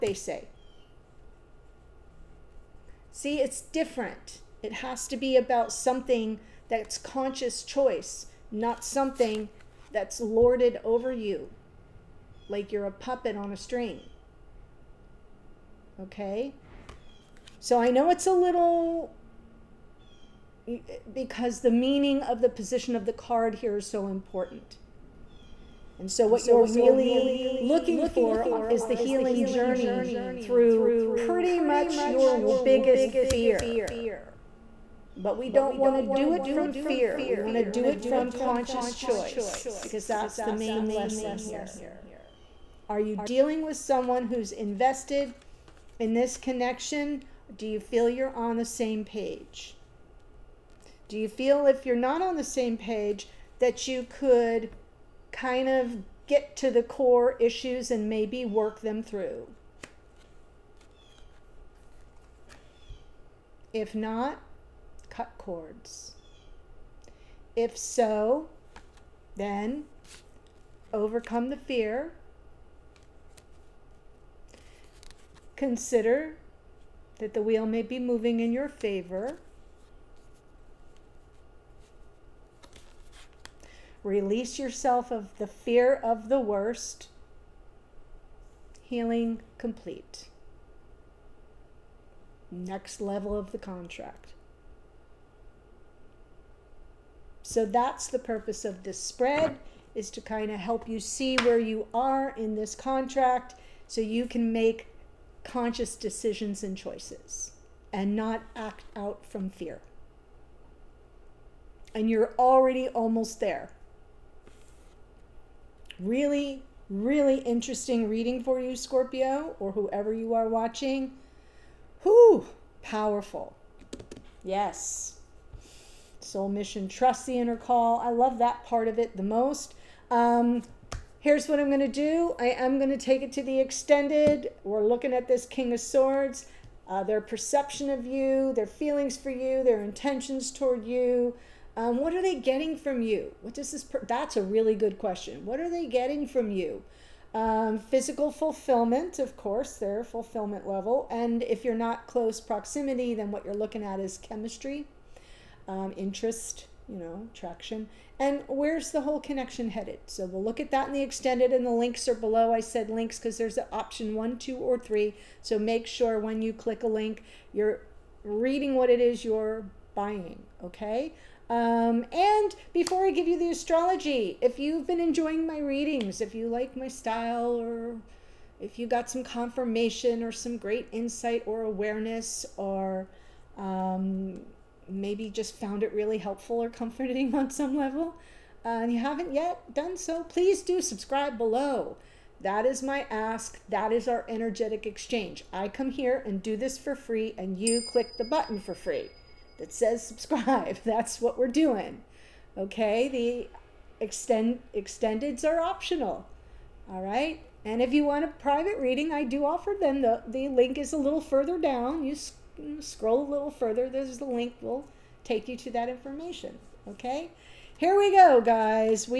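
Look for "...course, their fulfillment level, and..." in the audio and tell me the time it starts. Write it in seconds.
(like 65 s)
149 s.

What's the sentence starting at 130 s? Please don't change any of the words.
Um, here's what I'm going to do.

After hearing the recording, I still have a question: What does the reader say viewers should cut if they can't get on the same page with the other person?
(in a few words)
Cords.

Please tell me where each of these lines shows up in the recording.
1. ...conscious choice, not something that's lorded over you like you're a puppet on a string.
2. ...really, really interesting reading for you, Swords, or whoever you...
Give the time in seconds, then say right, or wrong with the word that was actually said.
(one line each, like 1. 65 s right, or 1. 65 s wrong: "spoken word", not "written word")
1. 6 s right
2. 115 s wrong: "Scorpio", not "Swords".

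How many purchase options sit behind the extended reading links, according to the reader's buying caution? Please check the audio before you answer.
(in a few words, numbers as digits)
3.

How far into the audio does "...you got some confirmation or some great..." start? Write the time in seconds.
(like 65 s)
178 s.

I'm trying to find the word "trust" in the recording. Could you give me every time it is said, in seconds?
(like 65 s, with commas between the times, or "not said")
126 s.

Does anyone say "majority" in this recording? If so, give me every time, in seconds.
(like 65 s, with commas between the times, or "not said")
not said.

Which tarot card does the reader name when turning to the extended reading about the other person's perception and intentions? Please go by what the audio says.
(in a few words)
King of Swords.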